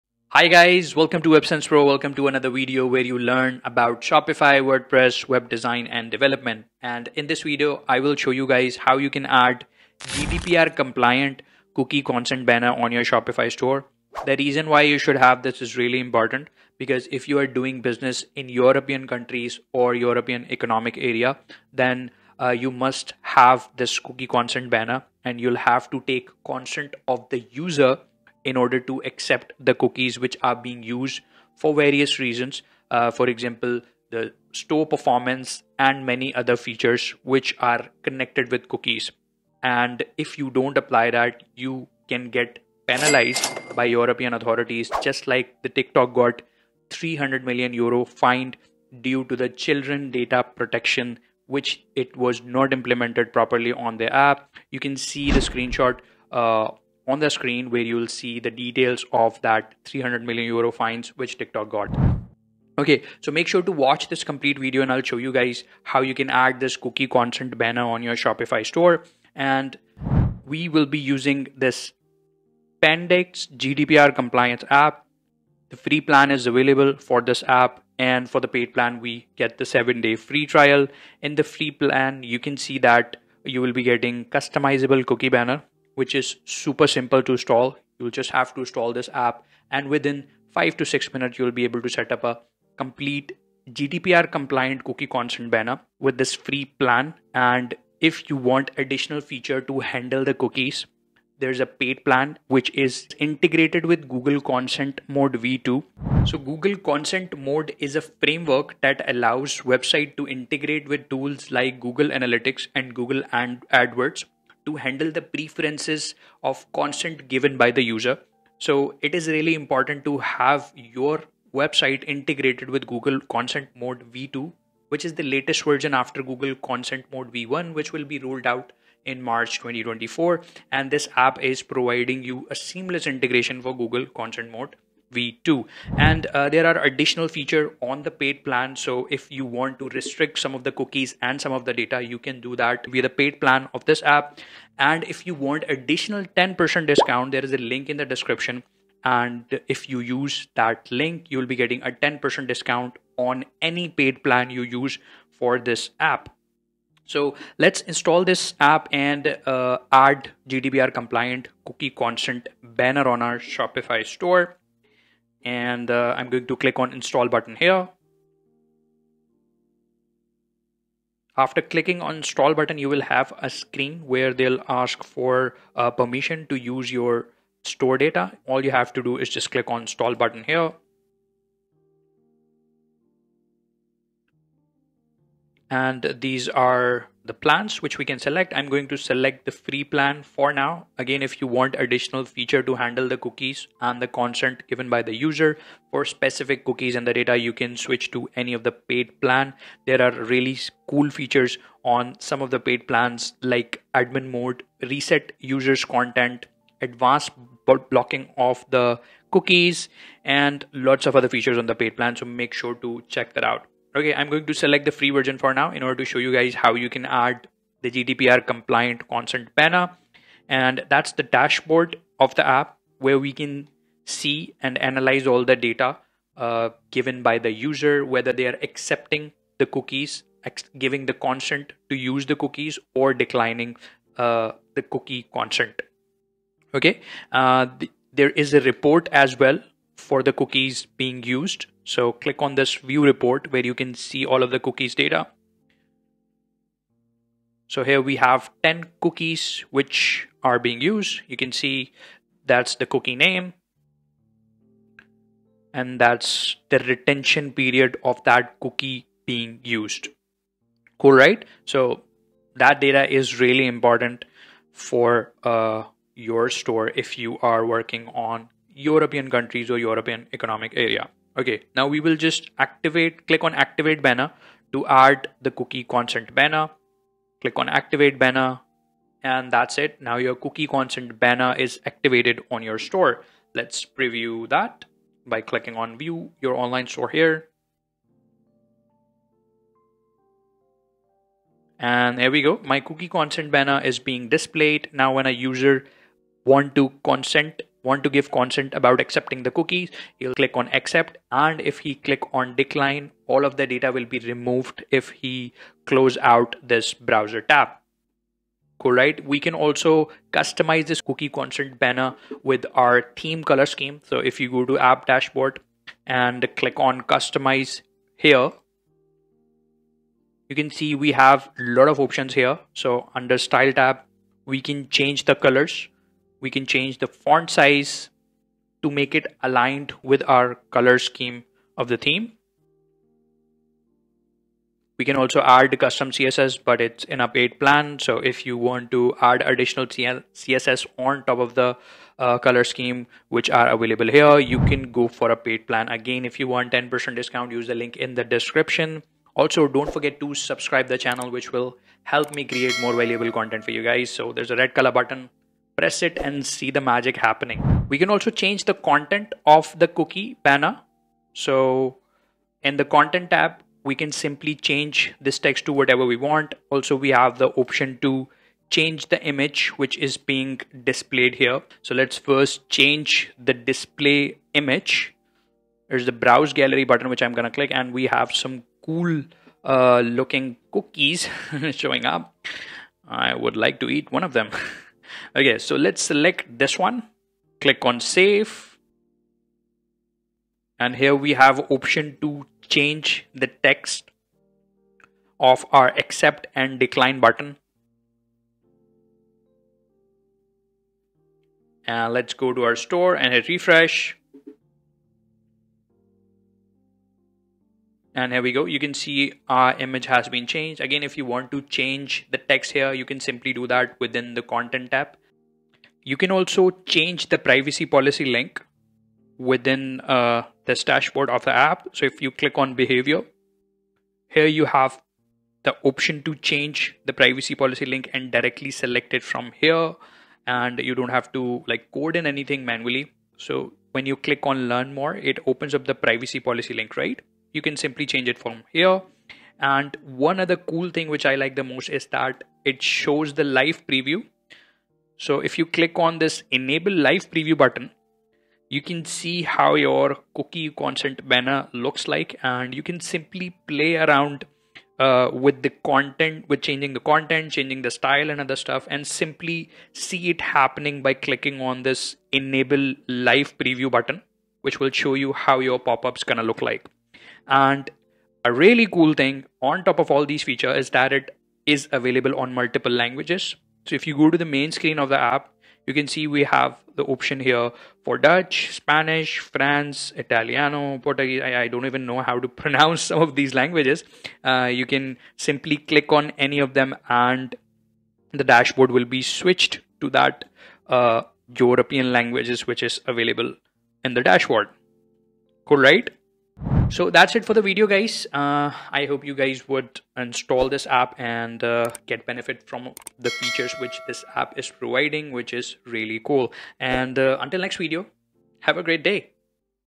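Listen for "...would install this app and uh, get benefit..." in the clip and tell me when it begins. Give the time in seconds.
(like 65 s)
499 s.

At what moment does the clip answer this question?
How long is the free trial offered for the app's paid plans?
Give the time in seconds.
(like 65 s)
79 s.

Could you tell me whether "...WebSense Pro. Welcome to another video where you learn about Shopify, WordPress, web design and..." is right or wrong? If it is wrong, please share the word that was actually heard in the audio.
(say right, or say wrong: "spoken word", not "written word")
right.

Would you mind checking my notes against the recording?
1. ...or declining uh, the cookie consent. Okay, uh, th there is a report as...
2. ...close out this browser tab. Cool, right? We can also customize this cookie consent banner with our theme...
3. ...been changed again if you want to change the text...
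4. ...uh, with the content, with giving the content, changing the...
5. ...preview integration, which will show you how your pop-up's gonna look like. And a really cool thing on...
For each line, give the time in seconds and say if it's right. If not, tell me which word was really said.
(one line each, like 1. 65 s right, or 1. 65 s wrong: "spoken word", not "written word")
1. 232 s right
2. 305 s right
3. 410 s right
4. 454 s wrong: "changing", not "giving"
5. 463 s wrong: "button", not "integration".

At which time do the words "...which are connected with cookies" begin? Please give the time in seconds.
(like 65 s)
37 s.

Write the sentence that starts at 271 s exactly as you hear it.
Okay, now we will just activate, click on activate banner to add the cookie consent banner.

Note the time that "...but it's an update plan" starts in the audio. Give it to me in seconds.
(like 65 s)
336 s.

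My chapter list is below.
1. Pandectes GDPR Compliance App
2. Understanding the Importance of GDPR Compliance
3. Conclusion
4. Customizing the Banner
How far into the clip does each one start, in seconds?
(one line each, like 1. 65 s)
1. 70 s
2. 19 s
3. 420 s
4. 310 s.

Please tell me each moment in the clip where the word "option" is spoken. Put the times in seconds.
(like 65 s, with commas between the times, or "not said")
321 s, 367 s, 391 s, 425 s, 477 s.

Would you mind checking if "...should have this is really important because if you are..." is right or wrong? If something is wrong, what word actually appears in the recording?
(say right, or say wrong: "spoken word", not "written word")
right.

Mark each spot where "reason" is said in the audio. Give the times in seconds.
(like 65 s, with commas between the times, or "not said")
14 s, 32 s.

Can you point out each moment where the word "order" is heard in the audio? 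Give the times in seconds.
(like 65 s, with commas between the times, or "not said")
28 s, 215 s.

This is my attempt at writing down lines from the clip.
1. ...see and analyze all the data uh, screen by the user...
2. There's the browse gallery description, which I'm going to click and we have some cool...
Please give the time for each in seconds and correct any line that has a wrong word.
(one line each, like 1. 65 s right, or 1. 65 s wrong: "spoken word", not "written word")
1. 224 s wrong: "given", not "screen"
2. 375 s wrong: "button", not "description".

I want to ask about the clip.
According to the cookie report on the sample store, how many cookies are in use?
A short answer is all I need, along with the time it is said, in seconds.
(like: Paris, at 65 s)
10, at 248 s.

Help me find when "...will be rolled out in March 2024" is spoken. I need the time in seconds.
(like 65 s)
127 s.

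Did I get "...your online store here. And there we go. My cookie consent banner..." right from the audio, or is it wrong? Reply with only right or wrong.
right.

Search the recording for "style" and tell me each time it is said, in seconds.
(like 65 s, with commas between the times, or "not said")
323 s, 457 s.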